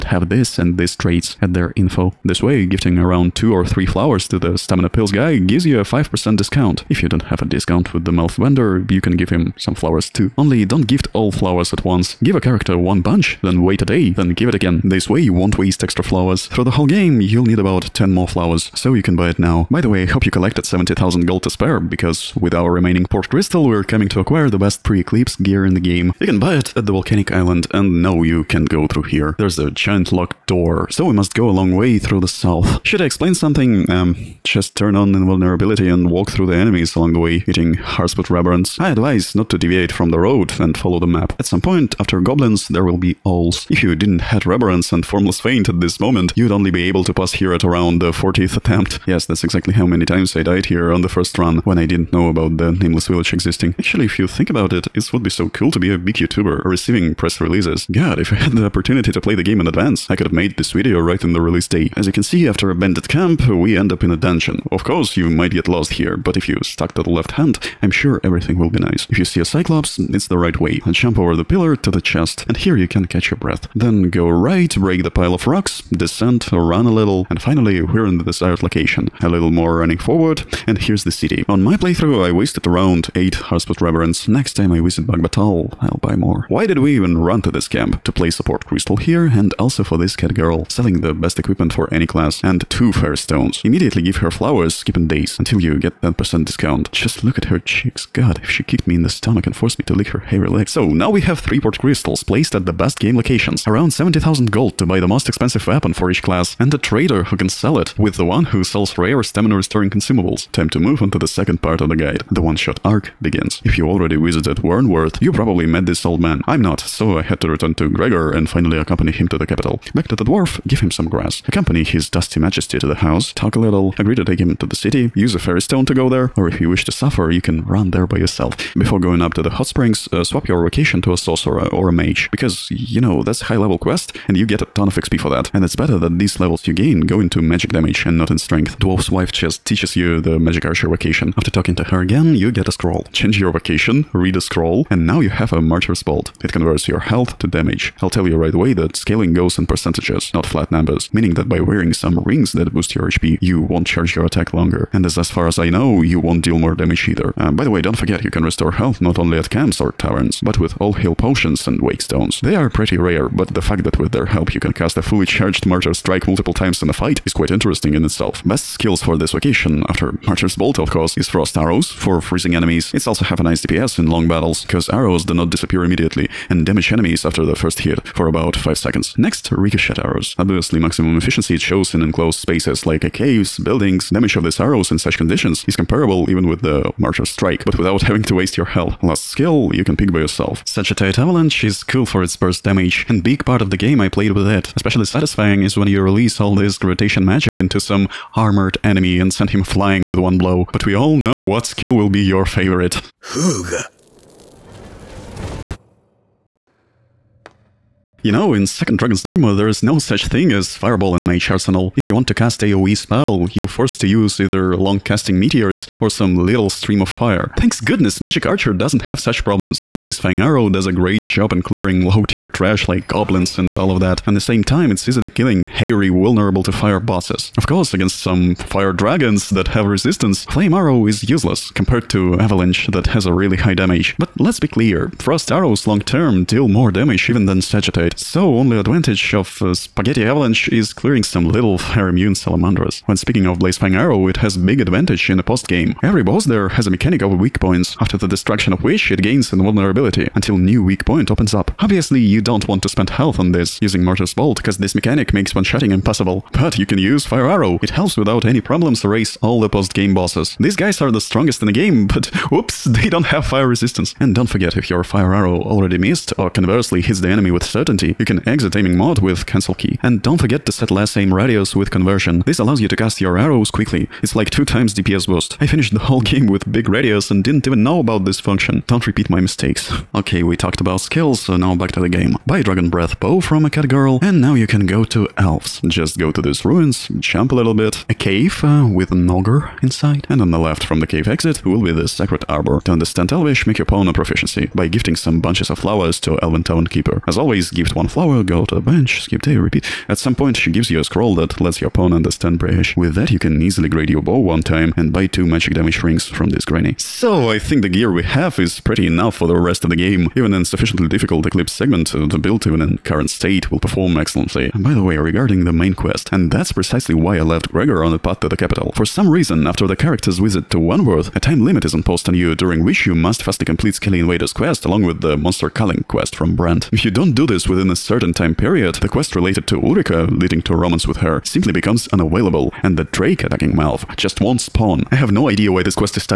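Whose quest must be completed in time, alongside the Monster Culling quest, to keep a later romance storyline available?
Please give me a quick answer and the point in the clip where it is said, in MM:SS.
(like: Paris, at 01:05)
Brant, at 05:26.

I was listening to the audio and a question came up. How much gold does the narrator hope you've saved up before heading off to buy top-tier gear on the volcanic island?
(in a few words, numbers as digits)
70,000.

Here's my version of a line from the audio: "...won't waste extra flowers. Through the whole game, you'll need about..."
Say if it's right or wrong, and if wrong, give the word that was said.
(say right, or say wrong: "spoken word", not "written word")
right.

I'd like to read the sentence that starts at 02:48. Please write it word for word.
Best skills for this vocation, after martyr's bolt of course, is thrust arrows for freezing enemies.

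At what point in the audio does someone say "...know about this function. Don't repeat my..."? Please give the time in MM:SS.
04:37.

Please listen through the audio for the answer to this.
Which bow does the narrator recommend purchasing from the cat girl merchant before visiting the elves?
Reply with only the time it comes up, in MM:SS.
04:42.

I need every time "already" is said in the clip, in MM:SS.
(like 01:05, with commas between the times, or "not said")
01:53, 04:25.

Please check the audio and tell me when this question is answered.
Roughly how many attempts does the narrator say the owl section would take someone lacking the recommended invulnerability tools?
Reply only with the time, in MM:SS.
00:48.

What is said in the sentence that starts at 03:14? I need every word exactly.
Especially satisfying is when you release all this gravitation magic into some armored enemy and send him flying with one blow.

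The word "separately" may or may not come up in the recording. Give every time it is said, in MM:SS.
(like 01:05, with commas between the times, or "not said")
not said.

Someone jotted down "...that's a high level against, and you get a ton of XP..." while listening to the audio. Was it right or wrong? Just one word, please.
wrong.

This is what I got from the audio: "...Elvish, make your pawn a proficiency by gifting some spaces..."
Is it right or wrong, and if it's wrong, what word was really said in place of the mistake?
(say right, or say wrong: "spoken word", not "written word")
wrong: "bunches", not "spaces".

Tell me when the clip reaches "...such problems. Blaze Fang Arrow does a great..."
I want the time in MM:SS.
03:39.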